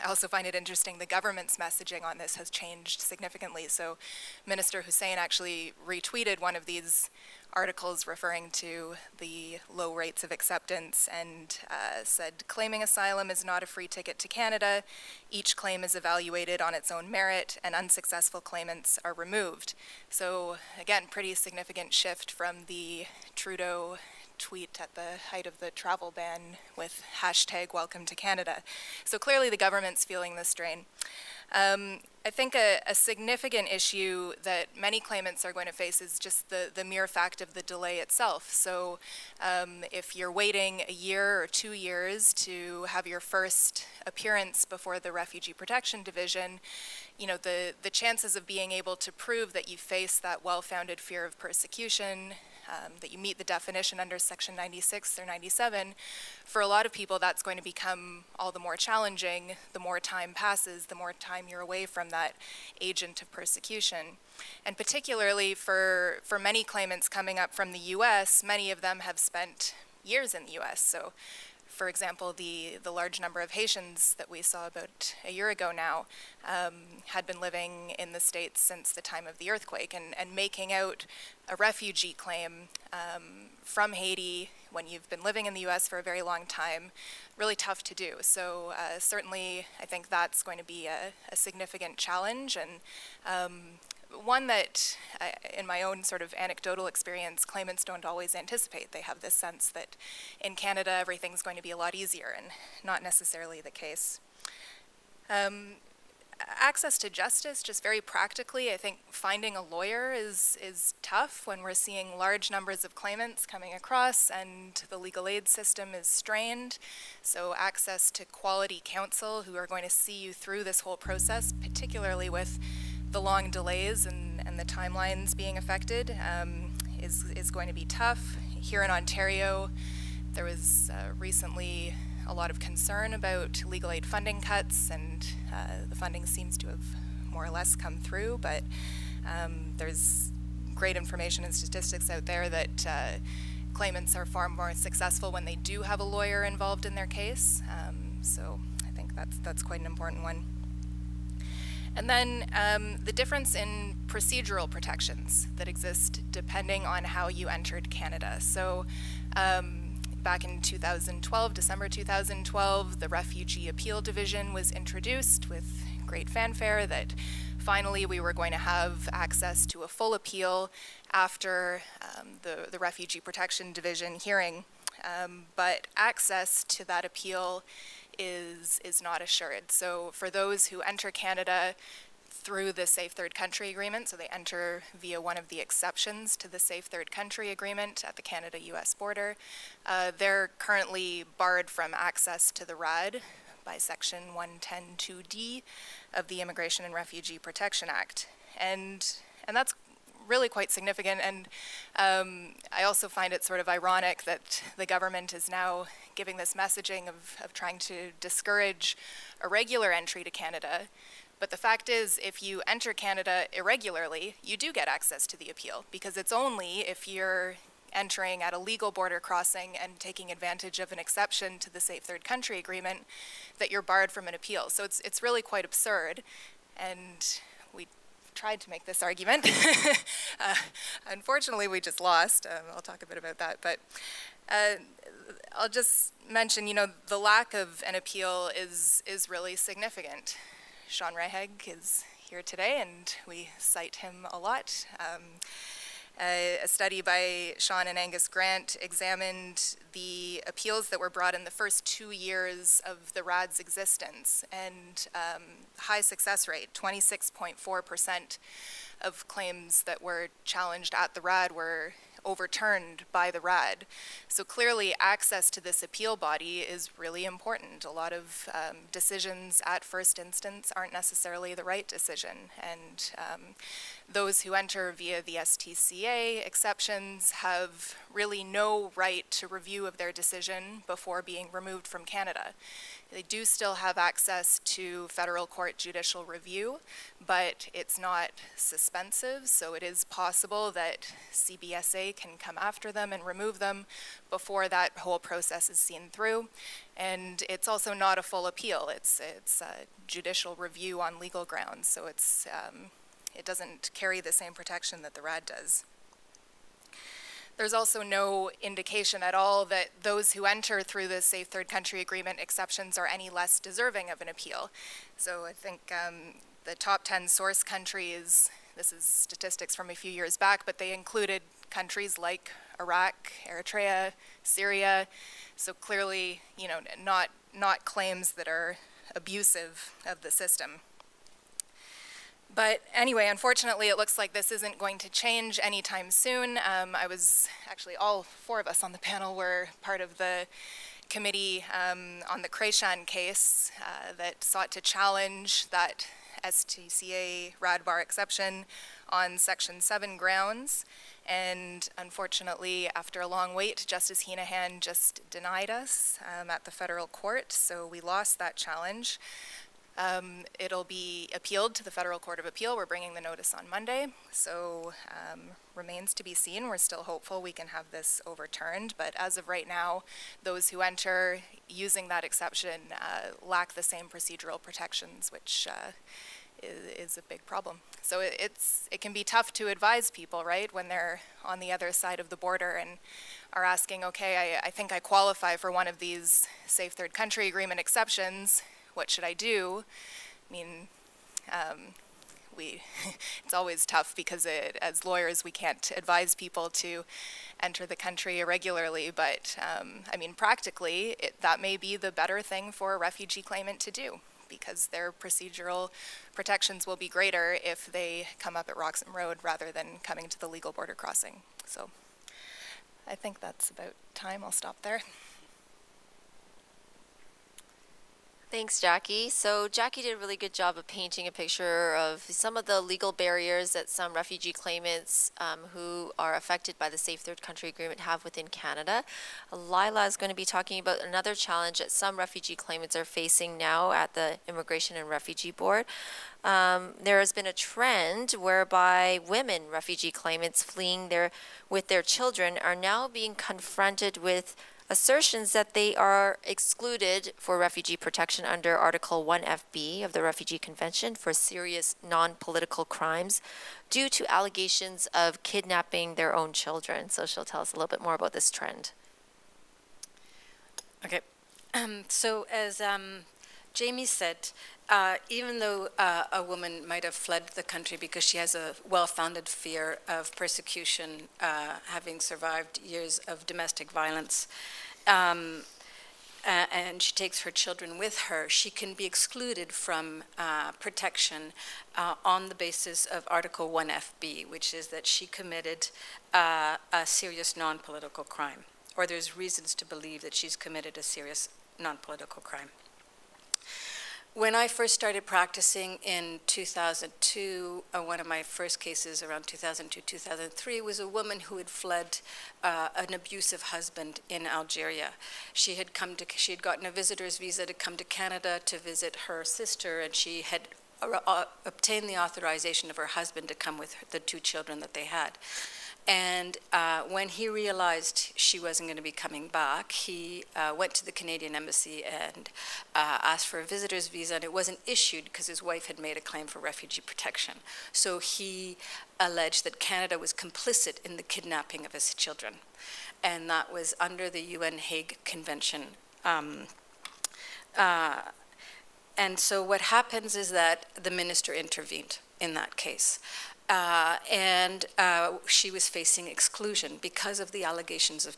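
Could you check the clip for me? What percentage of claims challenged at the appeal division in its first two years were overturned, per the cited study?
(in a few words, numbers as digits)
26.4%.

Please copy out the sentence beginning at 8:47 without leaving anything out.
So he alleged that Canada was complicit in the kidnapping of his children, and that was under the UN Hague Convention.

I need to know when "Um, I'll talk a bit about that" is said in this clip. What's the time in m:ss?
3:52.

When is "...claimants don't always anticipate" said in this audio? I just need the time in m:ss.
1:37.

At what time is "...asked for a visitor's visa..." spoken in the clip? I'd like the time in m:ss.
8:43.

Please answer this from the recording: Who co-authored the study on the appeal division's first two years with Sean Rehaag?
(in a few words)
Angus Grant.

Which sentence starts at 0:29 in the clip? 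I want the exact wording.
So clearly the government's feeling the strain.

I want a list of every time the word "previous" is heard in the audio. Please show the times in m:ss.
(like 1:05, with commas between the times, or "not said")
not said.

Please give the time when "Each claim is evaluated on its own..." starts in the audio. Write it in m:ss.
0:15.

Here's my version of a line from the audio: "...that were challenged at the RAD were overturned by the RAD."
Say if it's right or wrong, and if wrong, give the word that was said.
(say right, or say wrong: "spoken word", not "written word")
right.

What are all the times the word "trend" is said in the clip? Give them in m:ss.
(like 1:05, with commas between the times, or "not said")
7:17, 7:38.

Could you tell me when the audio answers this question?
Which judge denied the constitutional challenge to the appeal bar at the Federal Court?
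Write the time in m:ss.
5:53.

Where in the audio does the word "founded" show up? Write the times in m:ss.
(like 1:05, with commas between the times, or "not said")
0:50, 7:48.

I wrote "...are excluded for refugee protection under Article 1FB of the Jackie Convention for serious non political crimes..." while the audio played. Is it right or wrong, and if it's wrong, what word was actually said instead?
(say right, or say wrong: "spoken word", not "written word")
wrong: "Refugee", not "Jackie".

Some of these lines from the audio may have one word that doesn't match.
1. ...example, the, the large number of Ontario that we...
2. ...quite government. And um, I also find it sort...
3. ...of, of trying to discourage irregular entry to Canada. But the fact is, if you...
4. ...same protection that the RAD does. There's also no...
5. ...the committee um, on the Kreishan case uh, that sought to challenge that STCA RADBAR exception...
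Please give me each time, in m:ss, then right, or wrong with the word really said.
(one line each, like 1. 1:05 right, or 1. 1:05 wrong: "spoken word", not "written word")
1. 1:11 wrong: "Haitians", not "Ontario"
2. 3:20 wrong: "significant", not "government"
3. 3:27 right
4. 5:04 right
5. 5:40 right.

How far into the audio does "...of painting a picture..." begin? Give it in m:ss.
7:00.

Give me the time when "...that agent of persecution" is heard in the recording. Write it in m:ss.
1:02.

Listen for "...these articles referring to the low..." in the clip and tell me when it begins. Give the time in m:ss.
0:06.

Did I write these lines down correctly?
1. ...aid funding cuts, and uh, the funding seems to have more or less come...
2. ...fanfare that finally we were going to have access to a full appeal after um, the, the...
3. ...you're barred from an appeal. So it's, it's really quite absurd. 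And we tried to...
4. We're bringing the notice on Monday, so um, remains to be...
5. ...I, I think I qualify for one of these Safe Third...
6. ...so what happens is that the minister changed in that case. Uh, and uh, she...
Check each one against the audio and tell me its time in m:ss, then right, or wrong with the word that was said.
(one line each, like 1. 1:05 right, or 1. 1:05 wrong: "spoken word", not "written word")
1. 2:13 right
2. 2:46 right
3. 3:43 right
4. 6:02 right
5. 6:24 right
6. 8:59 wrong: "intervened", not "changed".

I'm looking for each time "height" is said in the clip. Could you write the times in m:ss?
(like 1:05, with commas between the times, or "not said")
0:25.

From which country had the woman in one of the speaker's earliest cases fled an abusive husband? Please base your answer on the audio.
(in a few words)
Algeria.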